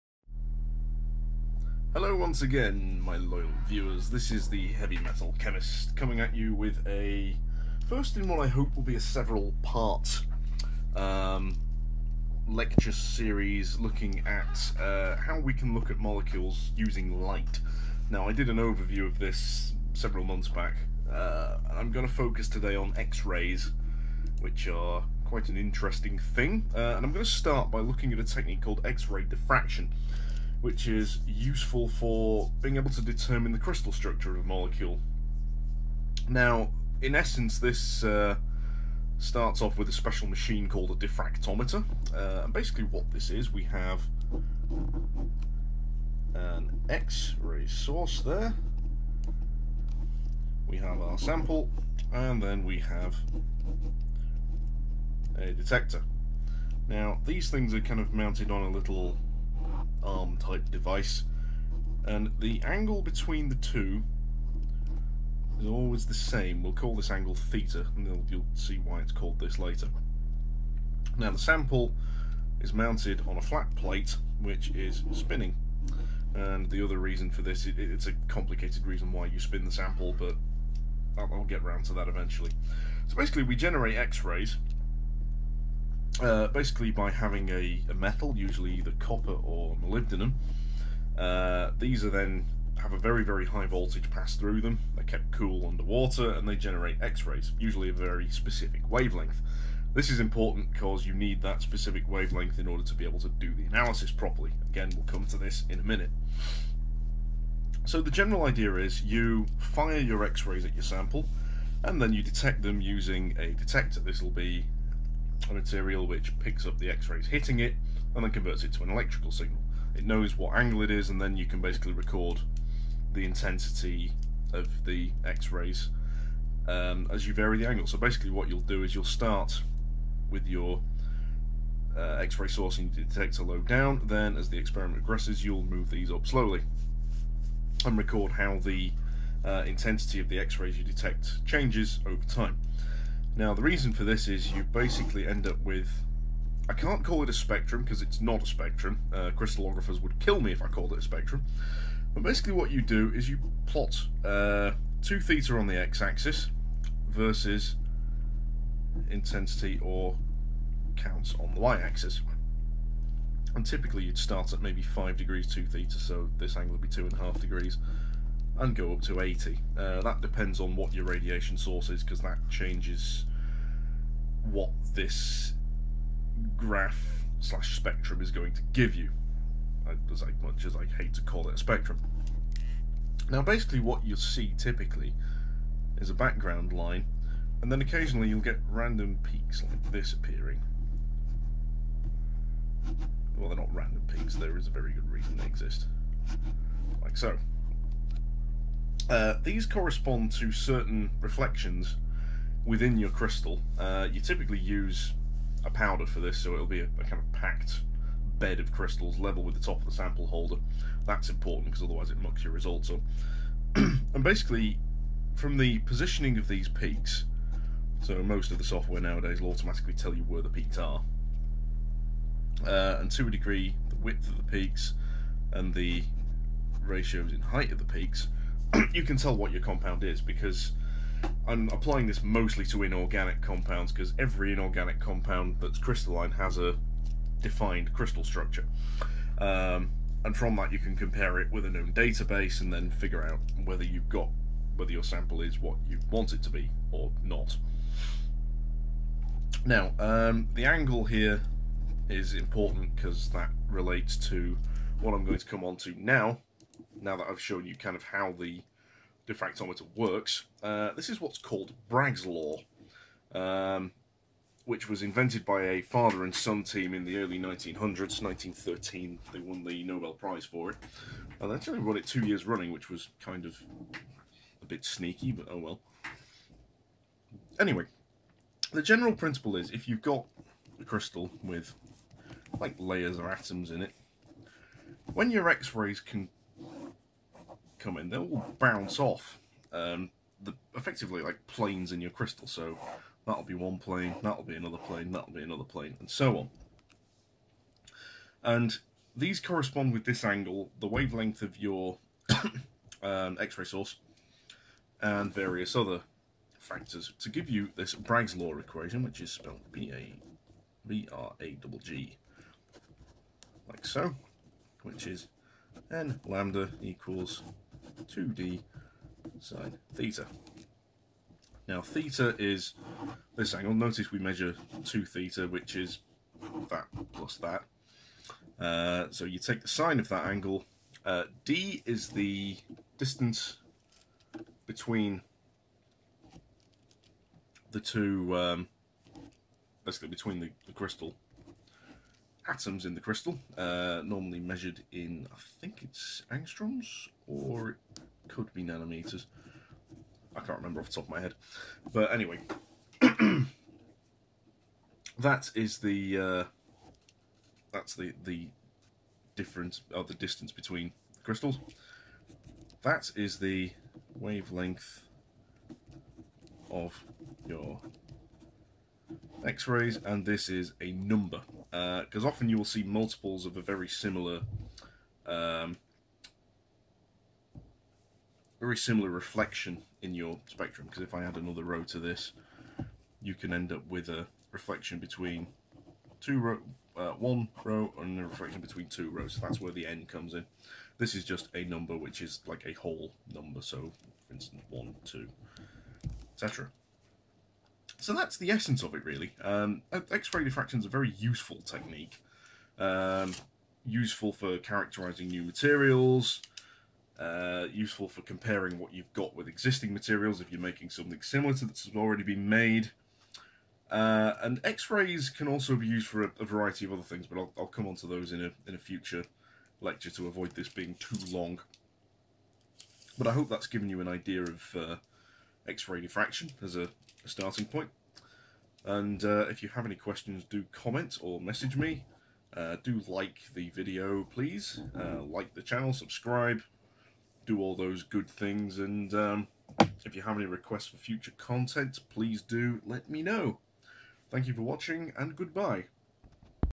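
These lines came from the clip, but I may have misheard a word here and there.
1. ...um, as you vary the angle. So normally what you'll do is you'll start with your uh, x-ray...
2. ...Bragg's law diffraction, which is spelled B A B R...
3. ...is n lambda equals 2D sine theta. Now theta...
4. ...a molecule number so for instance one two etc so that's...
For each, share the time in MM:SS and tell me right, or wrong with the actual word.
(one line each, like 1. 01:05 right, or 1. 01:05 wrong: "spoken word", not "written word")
1. 02:06 wrong: "basically", not "normally"
2. 05:07 wrong: "equation", not "diffraction"
3. 05:15 right
4. 06:32 wrong: "whole", not "molecule".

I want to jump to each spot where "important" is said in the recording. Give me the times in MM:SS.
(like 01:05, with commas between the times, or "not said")
01:40, 03:31, 04:12.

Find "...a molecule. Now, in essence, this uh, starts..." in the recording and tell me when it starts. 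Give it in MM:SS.
00:34.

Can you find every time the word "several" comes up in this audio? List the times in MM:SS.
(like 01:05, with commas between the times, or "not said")
00:09, 00:19.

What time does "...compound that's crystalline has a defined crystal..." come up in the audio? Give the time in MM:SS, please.
03:54.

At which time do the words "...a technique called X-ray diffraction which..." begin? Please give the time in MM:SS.
00:28.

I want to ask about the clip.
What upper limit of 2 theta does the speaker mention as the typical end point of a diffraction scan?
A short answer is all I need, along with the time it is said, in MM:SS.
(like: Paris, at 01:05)
80, at 02:49.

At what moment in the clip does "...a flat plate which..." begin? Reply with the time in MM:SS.
01:13.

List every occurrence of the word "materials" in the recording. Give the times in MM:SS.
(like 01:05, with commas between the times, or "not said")
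01:55, 06:45, 06:49.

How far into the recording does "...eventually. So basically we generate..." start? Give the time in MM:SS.
01:22.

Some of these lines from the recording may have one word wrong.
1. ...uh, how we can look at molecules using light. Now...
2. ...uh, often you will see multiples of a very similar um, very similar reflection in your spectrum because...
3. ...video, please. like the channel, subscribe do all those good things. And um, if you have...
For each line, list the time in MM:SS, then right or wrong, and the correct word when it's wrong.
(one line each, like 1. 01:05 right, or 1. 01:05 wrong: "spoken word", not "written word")
1. 00:14 right
2. 06:12 right
3. 07:13 right.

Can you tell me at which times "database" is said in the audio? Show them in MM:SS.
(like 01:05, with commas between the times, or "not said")
04:01.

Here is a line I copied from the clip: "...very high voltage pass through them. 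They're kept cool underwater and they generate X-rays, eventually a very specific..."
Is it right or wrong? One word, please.
wrong.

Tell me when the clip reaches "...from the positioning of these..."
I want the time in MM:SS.
03:35.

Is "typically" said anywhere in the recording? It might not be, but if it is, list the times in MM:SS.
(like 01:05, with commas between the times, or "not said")
02:43, 03:04, 03:24.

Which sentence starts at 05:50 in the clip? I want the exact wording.
I can't remember off the top of my head.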